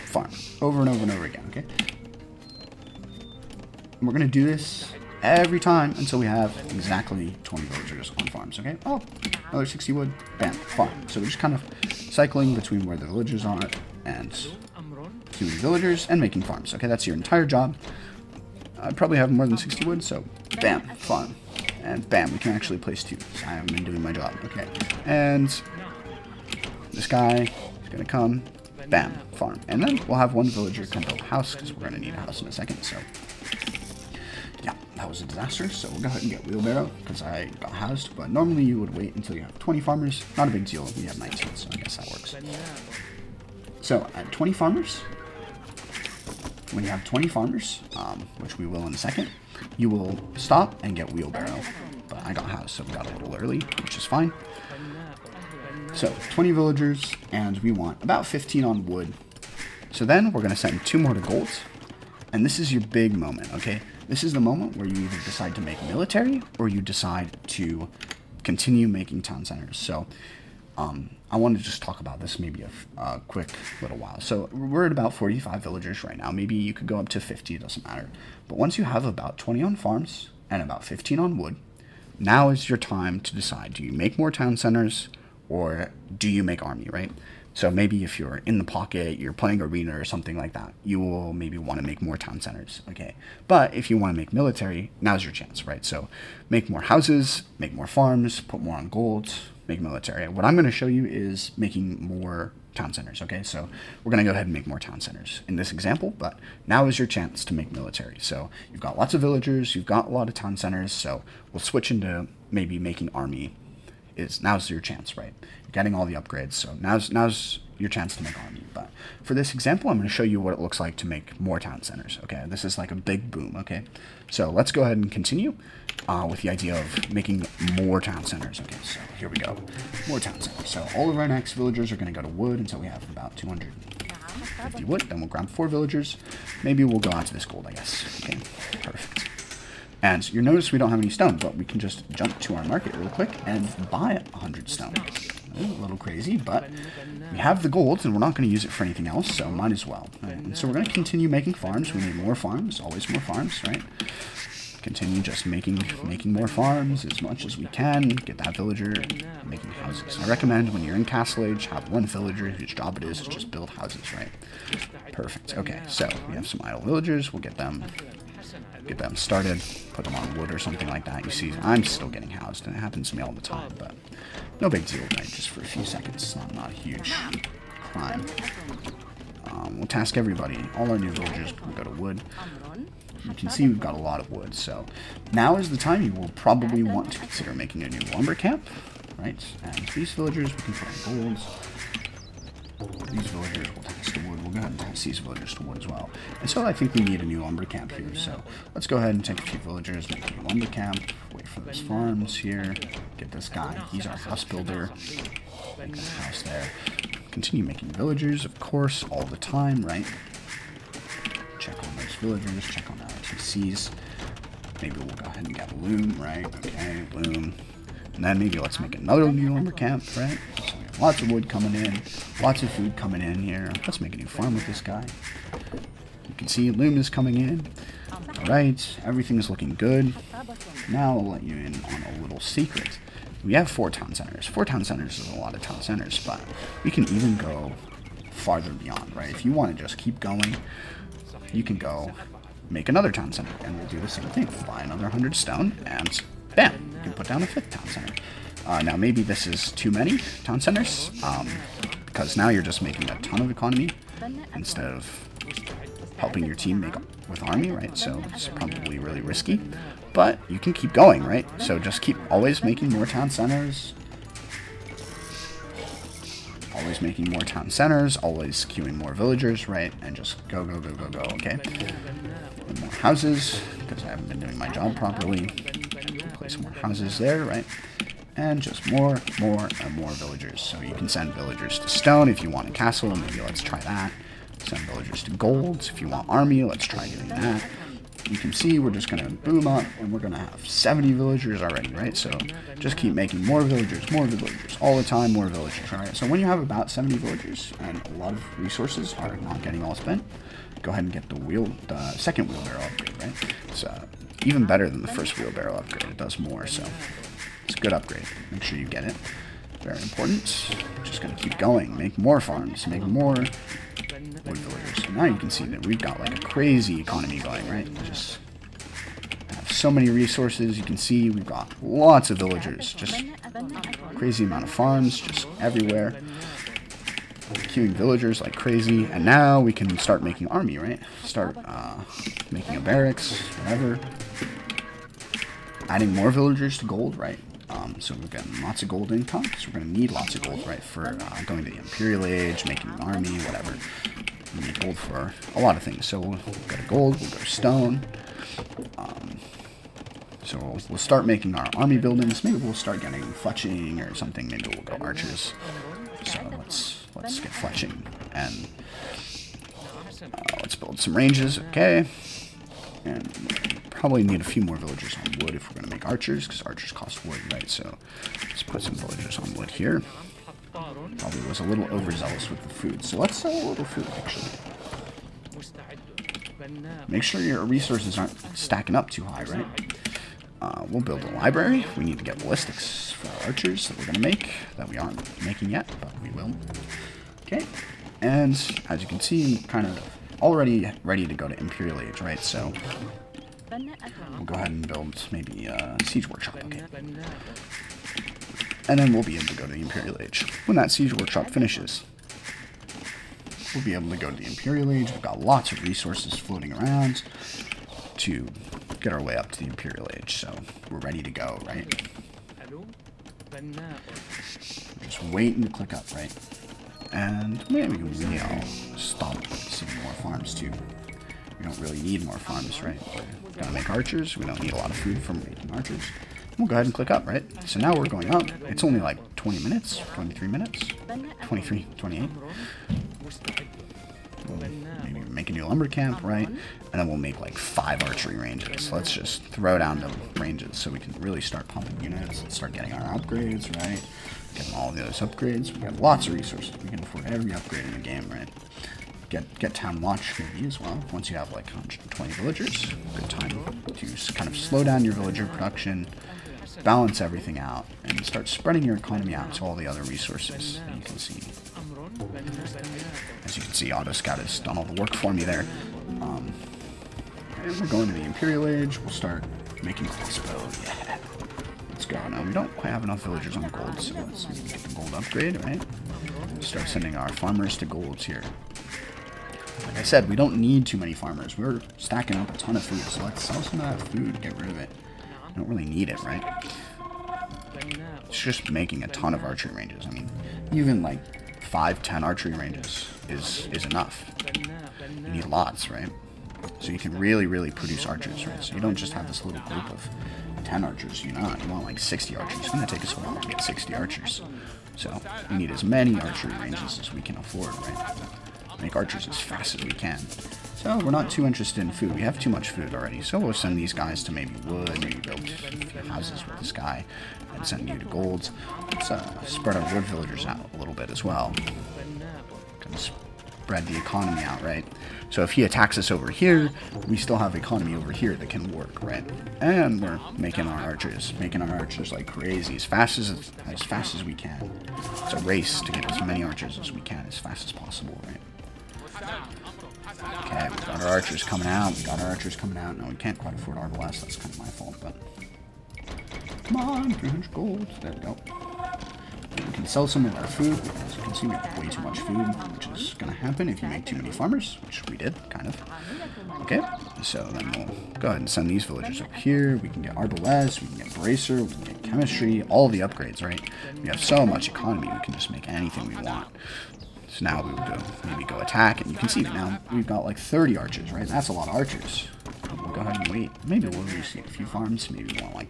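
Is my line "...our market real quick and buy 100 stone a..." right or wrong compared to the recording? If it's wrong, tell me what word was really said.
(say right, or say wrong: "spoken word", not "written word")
right.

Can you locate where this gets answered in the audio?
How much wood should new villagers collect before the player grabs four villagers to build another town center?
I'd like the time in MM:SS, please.
02:13.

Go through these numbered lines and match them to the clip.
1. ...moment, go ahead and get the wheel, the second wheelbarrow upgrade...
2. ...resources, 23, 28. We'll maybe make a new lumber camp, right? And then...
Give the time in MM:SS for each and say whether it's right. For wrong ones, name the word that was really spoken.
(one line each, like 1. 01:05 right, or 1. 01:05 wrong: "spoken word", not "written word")
1. 04:59 wrong: "spent", not "moment"
2. 07:10 wrong: "minutes", not "resources".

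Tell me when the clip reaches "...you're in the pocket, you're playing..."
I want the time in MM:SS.
01:28.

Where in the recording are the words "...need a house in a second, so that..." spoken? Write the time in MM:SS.
00:31.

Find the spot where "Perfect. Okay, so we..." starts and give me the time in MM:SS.
02:45.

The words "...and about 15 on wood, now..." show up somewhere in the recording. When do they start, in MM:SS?
01:20.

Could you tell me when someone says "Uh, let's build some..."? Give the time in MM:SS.
06:00.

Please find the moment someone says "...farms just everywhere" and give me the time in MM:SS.
05:24.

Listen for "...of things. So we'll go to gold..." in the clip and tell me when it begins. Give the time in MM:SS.
05:45.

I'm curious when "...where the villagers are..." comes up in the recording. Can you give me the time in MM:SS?
00:12.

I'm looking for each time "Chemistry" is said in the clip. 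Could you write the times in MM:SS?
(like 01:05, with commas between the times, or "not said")
09:22.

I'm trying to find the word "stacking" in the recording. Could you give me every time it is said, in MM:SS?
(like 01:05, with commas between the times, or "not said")
06:18, 08:01.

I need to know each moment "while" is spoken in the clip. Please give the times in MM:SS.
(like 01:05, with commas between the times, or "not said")
01:13, 08:23.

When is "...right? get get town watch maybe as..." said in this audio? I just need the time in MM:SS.
07:28.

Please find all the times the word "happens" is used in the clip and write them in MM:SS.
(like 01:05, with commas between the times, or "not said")
02:52, 09:13.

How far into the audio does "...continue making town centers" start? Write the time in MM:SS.
01:08.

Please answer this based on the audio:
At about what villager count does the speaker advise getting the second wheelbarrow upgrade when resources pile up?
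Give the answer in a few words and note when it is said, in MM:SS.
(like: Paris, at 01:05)
70, at 04:56.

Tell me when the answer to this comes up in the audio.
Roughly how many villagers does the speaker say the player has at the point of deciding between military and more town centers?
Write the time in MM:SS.
01:14.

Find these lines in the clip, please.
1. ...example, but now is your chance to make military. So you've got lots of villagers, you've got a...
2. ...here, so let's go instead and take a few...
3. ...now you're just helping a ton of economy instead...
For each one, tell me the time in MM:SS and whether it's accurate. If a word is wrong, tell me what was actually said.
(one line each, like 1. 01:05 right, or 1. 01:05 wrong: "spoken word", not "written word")
1. 01:45 right
2. 03:17 wrong: "ahead", not "instead"
3. 04:12 wrong: "making", not "helping".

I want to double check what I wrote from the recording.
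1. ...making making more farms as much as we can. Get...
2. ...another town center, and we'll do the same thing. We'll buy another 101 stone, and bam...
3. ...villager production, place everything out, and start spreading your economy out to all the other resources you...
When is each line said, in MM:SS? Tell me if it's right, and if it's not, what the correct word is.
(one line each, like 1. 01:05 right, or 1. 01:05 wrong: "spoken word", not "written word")
1. 02:35 right
2. 04:02 wrong: "100", not "101"
3. 07:35 wrong: "balance", not "place".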